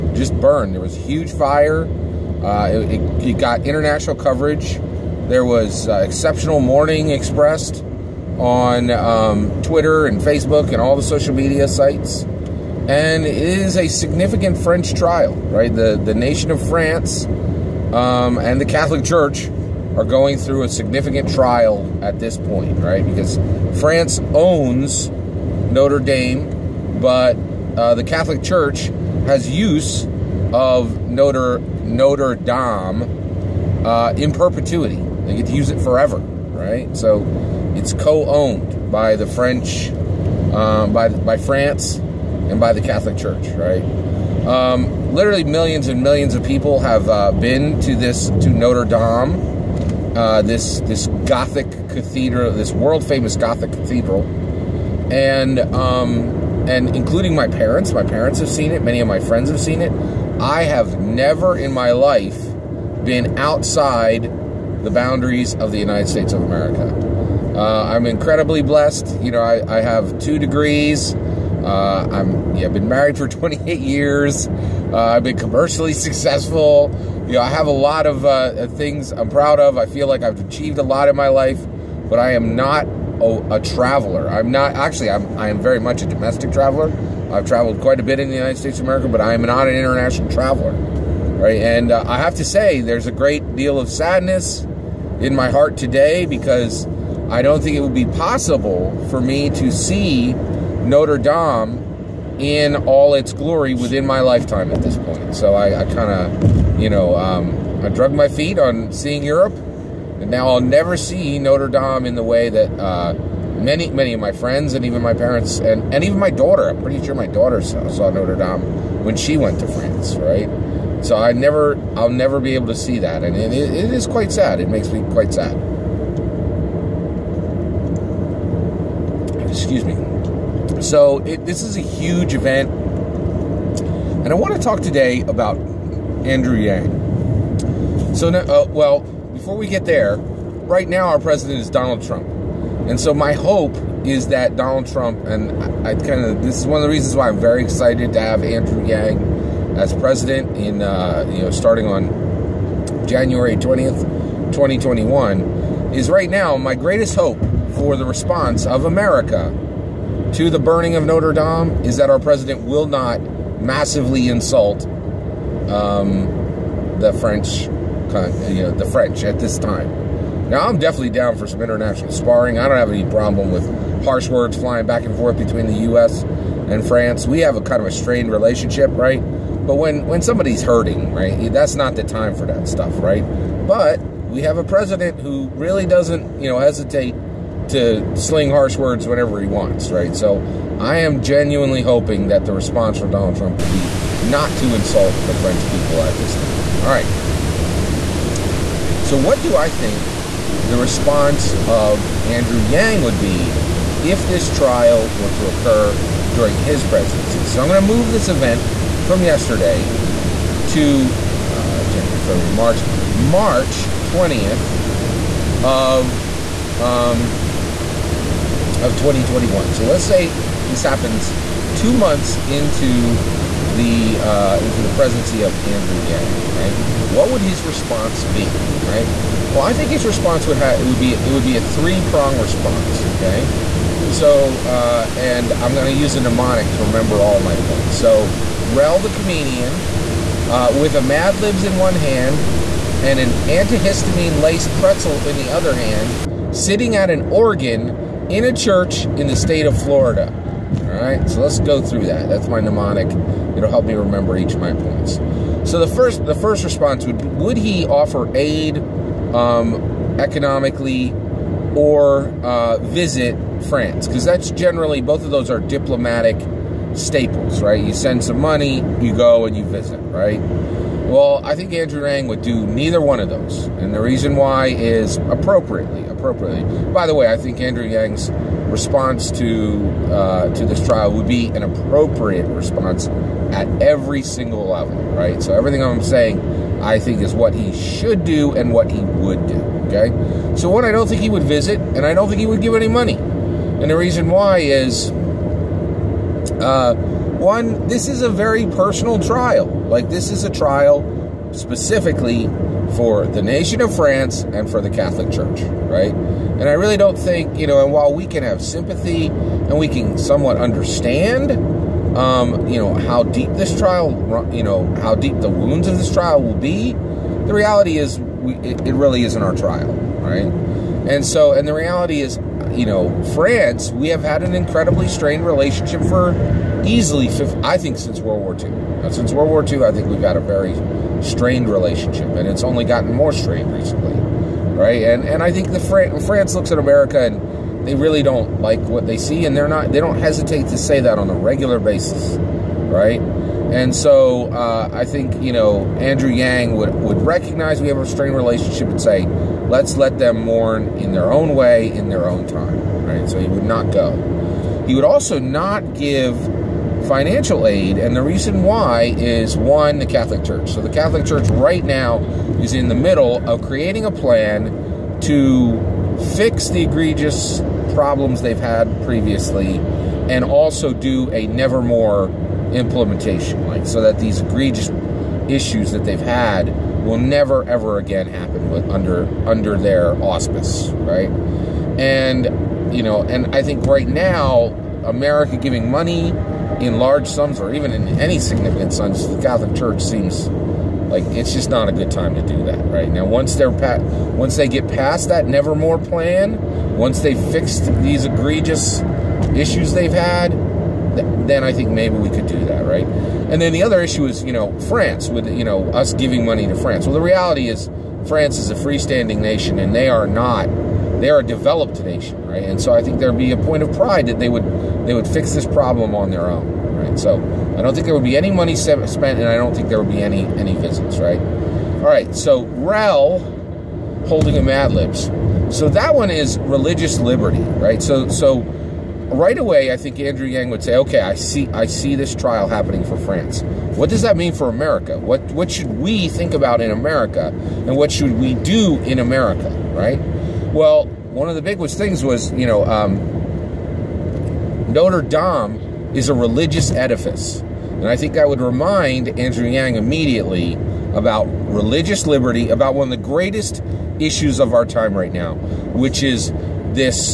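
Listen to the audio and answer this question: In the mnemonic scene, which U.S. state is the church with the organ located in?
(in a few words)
Florida.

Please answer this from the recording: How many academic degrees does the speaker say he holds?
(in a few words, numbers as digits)
2.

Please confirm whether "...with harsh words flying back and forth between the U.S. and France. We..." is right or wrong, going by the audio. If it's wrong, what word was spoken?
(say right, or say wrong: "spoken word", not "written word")
right.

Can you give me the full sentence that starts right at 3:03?
But we have a president who really doesn't, you know, hesitate to sling harsh words whenever he wants, right?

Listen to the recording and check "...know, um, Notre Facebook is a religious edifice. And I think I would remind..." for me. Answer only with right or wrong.
wrong.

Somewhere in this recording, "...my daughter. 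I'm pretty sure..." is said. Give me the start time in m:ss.
1:56.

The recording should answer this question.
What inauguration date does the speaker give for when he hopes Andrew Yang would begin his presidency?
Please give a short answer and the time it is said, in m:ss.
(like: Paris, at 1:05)
January 20th, 2021, at 2:33.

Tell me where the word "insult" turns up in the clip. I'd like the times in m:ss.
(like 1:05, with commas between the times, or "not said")
2:44, 3:14.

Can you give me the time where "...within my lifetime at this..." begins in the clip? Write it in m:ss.
1:43.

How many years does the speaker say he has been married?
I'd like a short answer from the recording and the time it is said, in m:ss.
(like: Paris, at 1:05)
28, at 1:13.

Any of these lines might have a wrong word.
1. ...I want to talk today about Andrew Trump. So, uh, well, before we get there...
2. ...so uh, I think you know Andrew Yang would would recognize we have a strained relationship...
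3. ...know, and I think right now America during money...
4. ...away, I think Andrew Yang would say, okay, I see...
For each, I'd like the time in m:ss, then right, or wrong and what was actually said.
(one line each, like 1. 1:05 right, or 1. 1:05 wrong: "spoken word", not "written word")
1. 2:14 wrong: "Yang", not "Trump"
2. 5:43 right
3. 6:23 wrong: "giving", not "during"
4. 7:09 right.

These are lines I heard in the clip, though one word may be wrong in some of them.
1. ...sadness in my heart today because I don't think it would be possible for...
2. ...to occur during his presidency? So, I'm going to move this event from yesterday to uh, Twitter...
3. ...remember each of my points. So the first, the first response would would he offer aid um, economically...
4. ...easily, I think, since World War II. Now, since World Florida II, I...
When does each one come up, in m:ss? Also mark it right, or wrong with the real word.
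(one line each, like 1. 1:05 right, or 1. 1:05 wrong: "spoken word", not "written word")
1. 1:33 right
2. 3:25 wrong: "January", not "Twitter"
3. 4:13 right
4. 5:26 wrong: "War", not "Florida".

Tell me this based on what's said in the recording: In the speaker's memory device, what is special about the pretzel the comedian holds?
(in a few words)
antihistamine laced.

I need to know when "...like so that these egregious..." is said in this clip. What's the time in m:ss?
6:13.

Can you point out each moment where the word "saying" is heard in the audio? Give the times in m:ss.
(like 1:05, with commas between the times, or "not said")
4:46.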